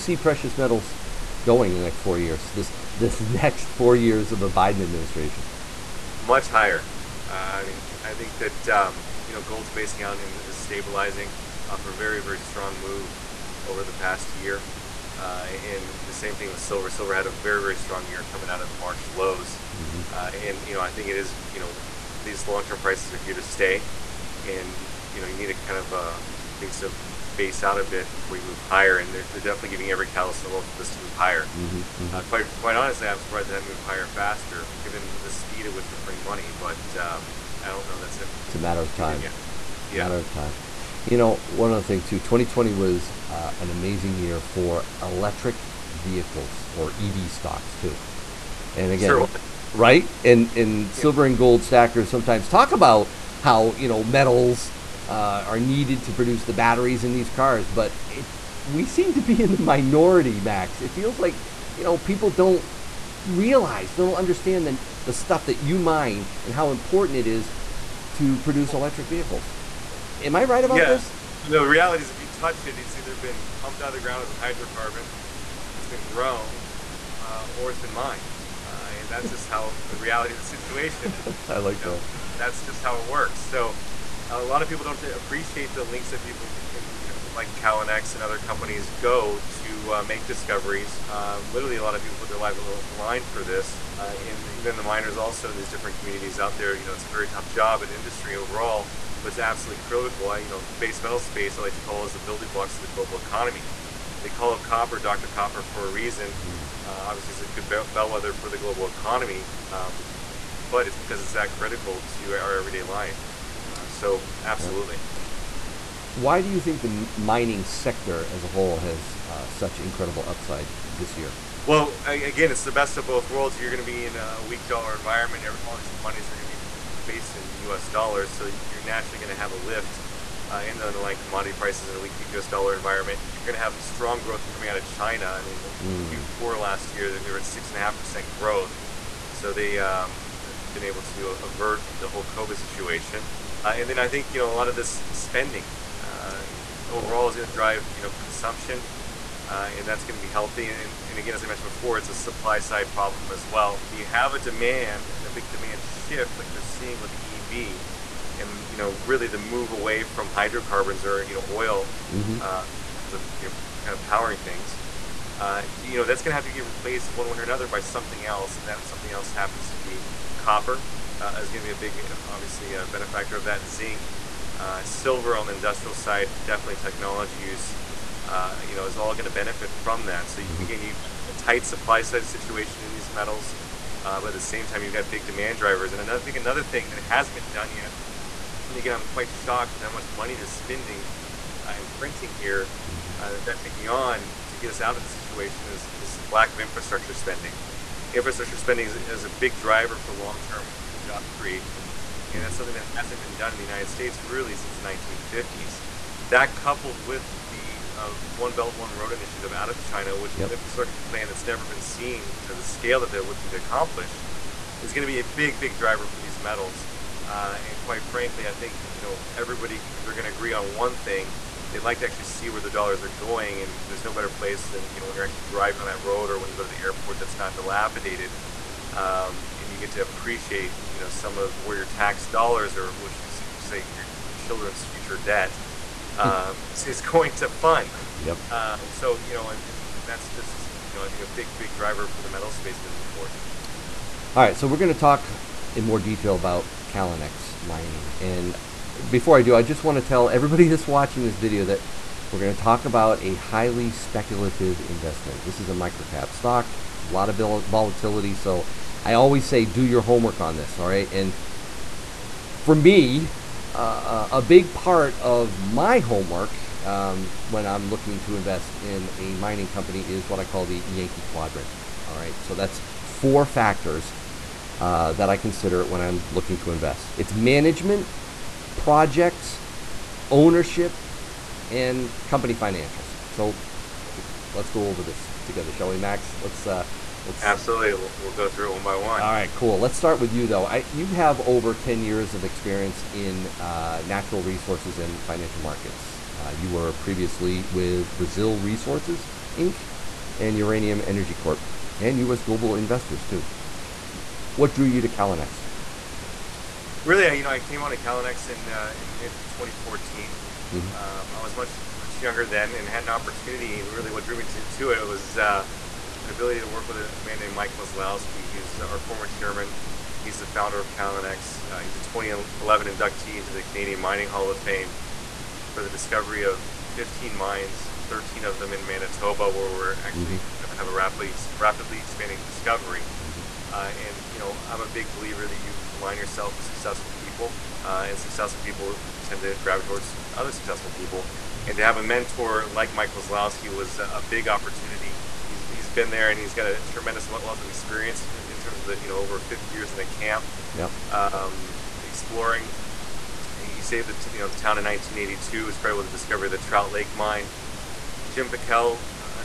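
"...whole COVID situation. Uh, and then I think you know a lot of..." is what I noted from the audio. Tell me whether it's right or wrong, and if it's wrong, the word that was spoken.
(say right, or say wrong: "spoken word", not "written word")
right.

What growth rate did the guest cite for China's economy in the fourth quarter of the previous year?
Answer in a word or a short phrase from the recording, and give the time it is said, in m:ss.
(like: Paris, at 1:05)
6.5%, at 2:17.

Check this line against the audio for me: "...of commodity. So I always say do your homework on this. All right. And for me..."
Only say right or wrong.
wrong.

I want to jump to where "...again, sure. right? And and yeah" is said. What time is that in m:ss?
0:48.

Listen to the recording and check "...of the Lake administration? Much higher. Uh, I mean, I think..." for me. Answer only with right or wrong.
wrong.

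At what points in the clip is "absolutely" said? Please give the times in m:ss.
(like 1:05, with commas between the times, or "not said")
1:39, 1:54, 4:47.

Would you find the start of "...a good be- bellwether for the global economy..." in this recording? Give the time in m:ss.
1:47.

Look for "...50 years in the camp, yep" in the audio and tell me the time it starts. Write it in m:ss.
5:49.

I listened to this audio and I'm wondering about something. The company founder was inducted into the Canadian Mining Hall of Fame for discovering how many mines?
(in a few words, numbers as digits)
15.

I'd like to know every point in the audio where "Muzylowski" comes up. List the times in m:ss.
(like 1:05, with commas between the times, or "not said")
5:17, 5:43.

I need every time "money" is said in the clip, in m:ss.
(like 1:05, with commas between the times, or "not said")
0:36, 3:10.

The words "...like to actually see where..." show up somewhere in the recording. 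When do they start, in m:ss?
3:41.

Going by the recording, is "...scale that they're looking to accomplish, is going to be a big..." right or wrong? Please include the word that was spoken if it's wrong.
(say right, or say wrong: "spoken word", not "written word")
right.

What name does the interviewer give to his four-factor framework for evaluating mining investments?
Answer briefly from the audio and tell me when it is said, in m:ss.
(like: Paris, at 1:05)
Yankee quadrant, at 4:30.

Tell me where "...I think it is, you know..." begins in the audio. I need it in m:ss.
0:20.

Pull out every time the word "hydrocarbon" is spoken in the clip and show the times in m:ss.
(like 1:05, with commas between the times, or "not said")
1:14, 2:40.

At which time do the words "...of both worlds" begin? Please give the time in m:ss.
2:02.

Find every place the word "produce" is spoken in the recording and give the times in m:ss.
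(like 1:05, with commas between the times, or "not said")
0:56, 1:08.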